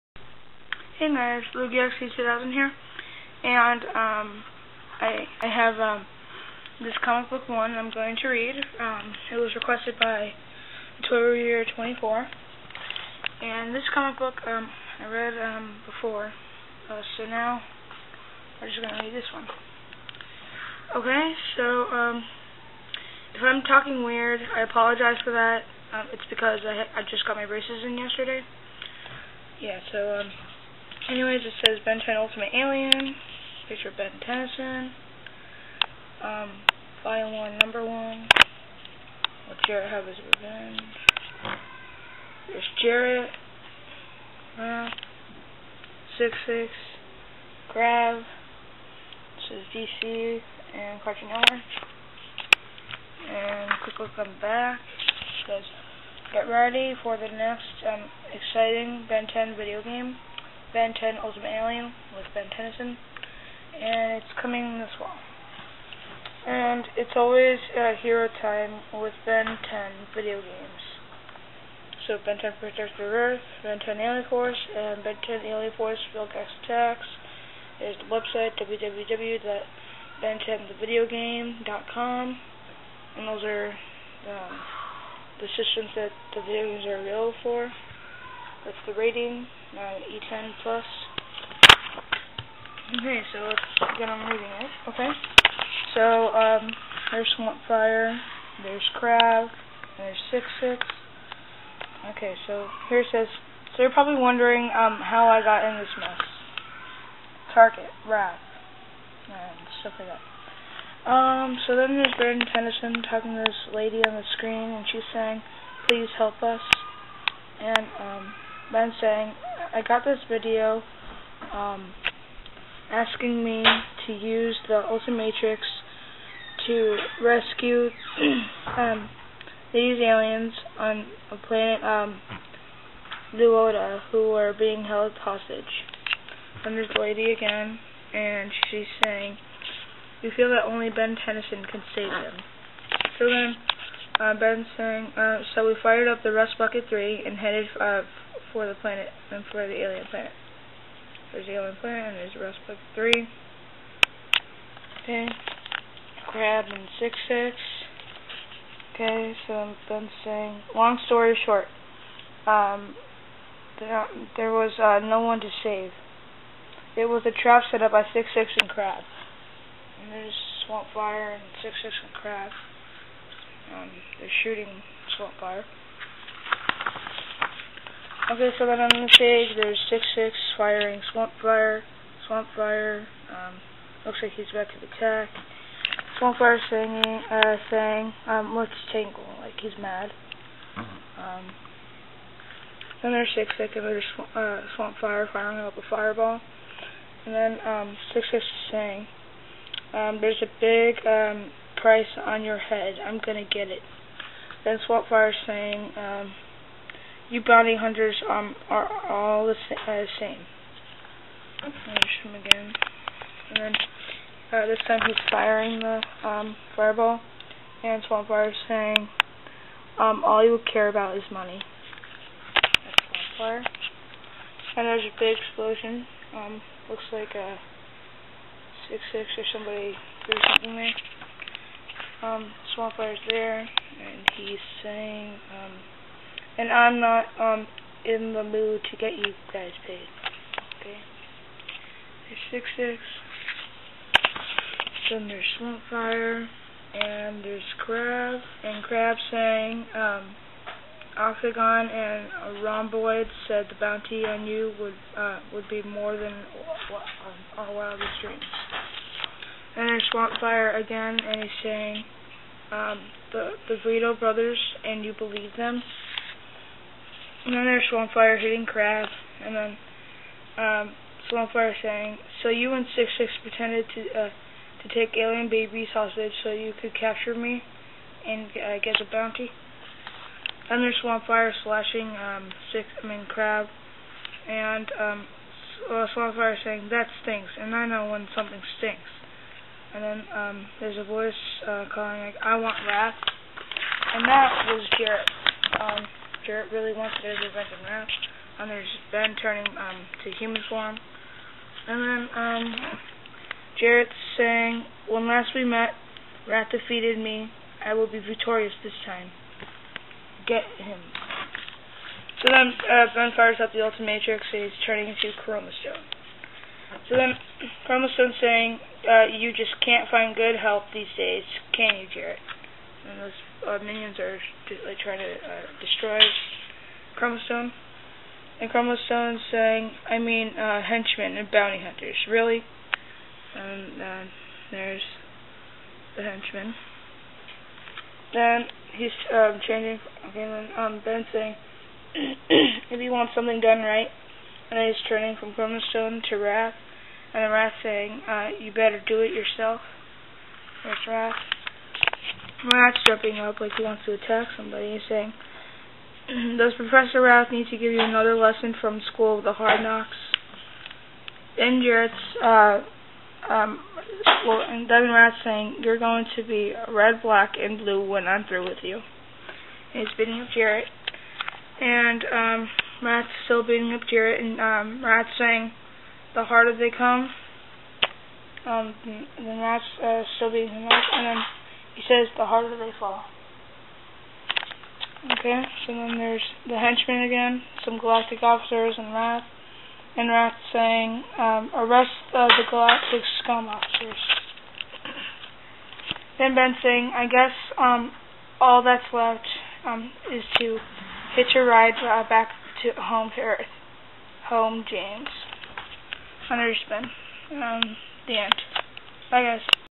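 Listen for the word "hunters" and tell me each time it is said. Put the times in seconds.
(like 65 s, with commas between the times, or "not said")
207 s, 331 s, 406 s.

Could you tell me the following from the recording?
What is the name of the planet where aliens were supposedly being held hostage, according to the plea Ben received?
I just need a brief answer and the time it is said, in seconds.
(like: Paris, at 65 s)
Luoda, at 133 s.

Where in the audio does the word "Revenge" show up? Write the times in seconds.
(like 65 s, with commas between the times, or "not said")
40 s.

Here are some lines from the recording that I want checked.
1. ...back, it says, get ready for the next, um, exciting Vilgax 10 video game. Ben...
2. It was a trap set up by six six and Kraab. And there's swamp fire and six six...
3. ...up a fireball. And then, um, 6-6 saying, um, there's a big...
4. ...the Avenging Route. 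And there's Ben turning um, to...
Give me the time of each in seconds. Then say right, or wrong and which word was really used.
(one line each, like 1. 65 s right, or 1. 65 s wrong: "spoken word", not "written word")
1. 54 s wrong: "Ben", not "Vilgax"
2. 166 s right
3. 195 s right
4. 297 s right.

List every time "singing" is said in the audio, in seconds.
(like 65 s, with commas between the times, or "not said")
186 s.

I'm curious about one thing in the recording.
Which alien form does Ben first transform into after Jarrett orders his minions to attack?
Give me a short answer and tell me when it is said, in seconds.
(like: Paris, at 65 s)
Chromastone, at 315 s.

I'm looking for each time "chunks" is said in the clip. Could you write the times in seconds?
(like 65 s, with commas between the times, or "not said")
not said.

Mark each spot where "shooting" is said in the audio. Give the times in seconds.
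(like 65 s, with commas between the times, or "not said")
174 s.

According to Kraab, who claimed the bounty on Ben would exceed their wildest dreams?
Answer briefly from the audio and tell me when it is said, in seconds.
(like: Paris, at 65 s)
Octagon and Rhomboid, at 251 s.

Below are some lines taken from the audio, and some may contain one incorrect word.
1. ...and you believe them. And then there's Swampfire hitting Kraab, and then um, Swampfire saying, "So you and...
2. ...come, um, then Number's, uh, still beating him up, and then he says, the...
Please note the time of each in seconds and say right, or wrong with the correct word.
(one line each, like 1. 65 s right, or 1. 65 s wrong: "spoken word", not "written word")
1. 264 s right
2. 376 s wrong: "Rat", not "Number".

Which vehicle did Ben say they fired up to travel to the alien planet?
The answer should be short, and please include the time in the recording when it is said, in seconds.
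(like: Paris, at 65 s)
Rust Bucket 3, at 146 s.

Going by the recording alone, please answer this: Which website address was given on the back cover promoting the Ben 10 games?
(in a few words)
www.ben10thevideogame.com.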